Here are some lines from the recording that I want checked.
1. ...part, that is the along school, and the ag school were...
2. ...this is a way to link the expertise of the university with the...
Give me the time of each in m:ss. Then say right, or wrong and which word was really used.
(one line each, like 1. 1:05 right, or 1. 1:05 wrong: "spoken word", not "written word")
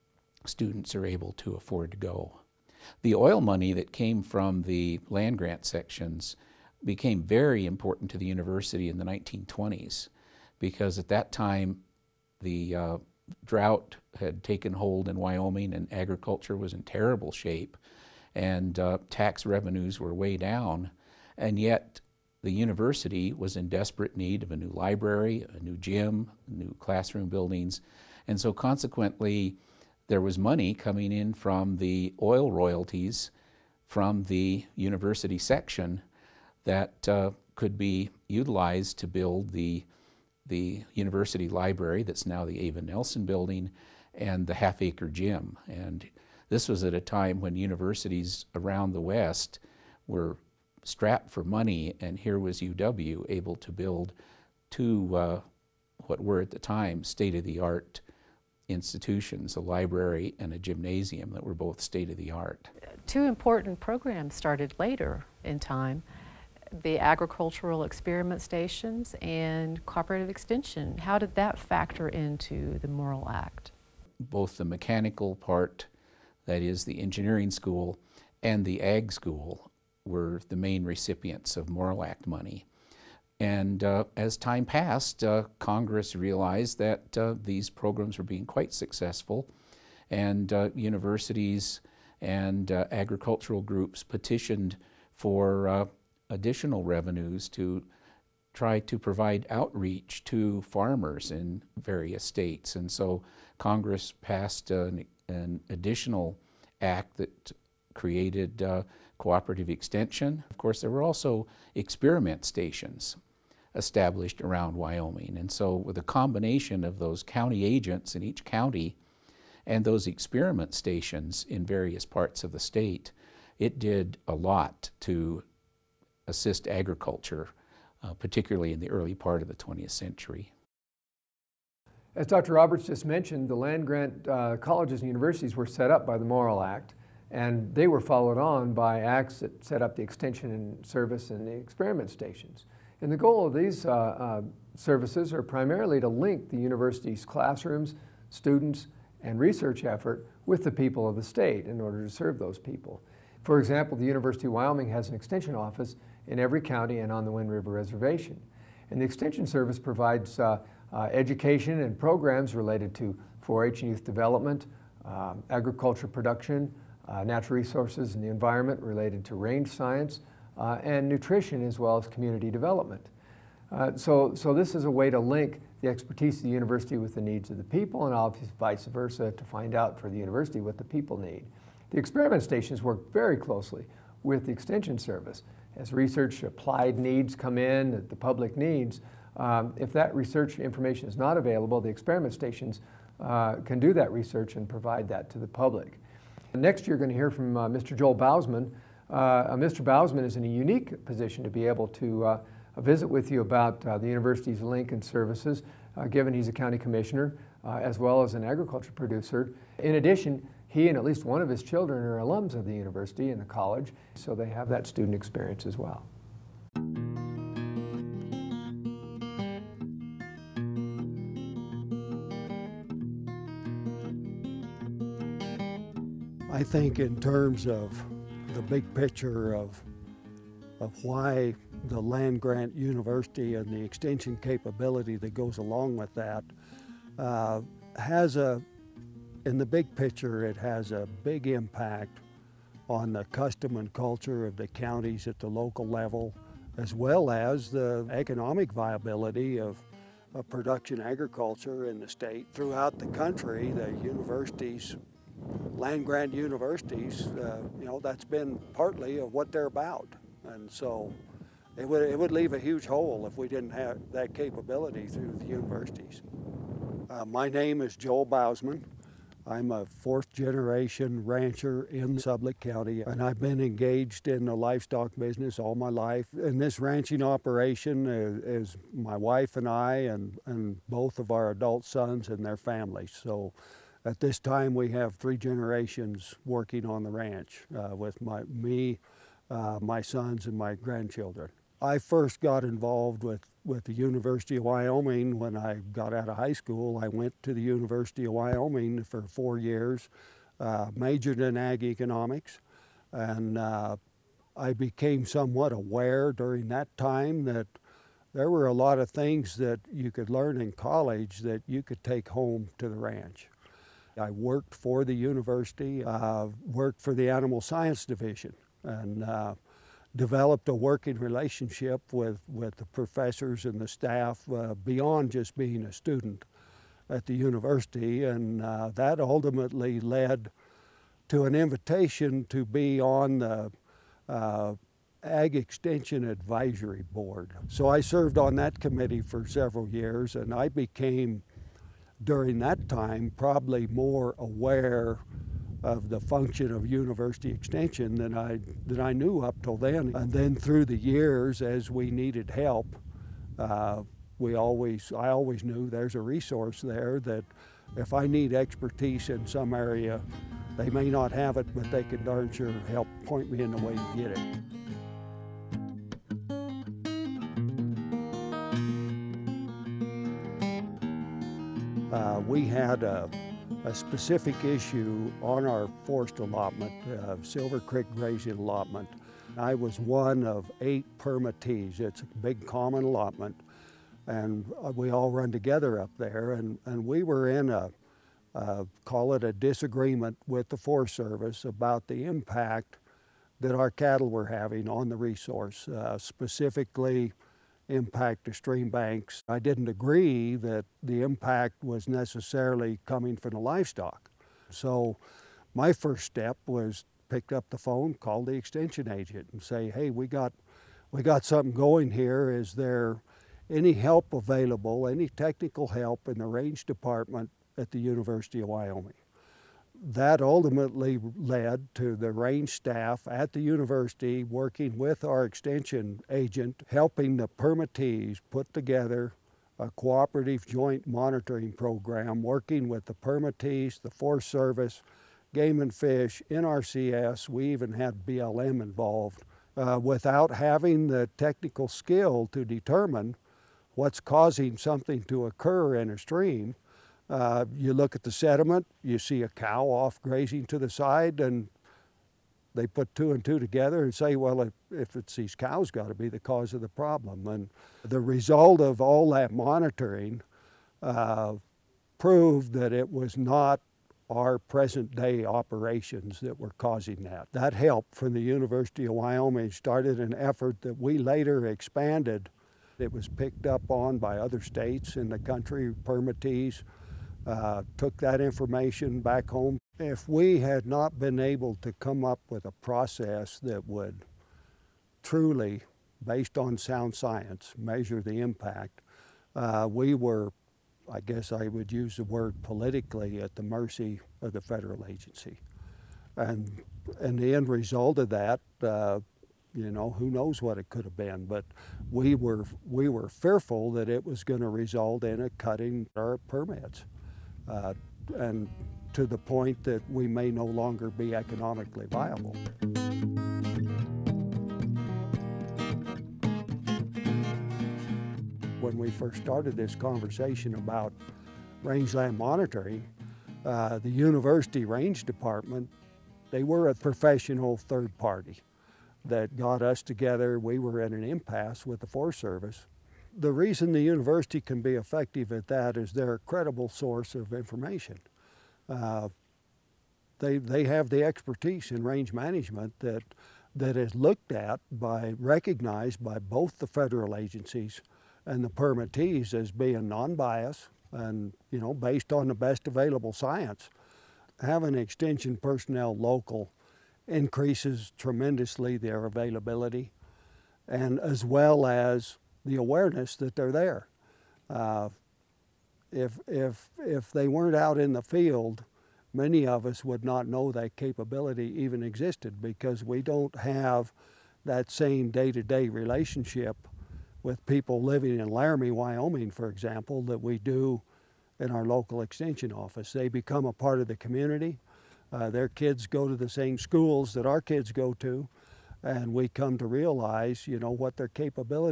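1. 1:15 wrong: "engineering", not "along"
2. 2:54 right.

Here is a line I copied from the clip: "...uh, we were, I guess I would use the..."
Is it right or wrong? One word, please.
right.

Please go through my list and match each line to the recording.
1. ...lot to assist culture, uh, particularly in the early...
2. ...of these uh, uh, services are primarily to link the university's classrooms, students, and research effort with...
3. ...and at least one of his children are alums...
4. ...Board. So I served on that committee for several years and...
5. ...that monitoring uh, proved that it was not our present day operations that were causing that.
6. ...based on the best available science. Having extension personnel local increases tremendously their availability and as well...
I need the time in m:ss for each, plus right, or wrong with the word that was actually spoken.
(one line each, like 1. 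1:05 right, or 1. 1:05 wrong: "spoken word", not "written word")
1. 2:04 wrong: "agriculture", not "culture"
2. 2:23 right
3. 3:30 right
4. 5:37 right
5. 7:39 right
6. 9:11 right.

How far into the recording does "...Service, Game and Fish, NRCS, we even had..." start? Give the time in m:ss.
7:14.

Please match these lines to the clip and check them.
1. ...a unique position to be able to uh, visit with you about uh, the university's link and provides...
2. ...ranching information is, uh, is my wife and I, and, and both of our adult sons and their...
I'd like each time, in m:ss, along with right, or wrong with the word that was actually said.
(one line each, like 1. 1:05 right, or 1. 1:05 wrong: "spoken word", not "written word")
1. 3:20 wrong: "services", not "provides"
2. 4:36 wrong: "operation", not "information".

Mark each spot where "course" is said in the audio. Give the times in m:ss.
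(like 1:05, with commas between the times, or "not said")
1:50.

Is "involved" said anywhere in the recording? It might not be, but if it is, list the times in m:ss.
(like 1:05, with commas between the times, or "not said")
4:52, 7:18.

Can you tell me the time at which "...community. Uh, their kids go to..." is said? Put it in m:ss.
9:44.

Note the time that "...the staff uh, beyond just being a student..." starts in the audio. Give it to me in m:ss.
5:23.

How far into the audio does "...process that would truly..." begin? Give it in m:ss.
8:02.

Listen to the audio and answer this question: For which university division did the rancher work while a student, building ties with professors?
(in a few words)
Animal Science Division.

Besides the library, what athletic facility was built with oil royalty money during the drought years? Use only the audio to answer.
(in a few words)
half acre gym.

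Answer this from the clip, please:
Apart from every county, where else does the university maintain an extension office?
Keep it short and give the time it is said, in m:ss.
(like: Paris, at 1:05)
Wind River Reservation, at 2:37.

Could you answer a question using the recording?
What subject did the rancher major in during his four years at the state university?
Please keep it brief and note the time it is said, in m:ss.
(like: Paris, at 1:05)
ag economics, at 5:01.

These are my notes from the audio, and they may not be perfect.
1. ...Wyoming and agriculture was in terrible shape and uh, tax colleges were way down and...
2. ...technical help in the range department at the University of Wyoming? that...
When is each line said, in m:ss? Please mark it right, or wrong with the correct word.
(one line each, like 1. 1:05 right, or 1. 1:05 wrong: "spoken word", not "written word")
1. 0:15 wrong: "revenues", not "colleges"
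2. 6:55 right.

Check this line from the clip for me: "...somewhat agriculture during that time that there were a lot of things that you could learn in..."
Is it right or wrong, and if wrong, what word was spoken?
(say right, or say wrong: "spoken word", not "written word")
wrong: "aware", not "agriculture".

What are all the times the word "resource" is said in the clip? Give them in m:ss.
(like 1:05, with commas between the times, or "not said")
2:47, 5:56, 6:35.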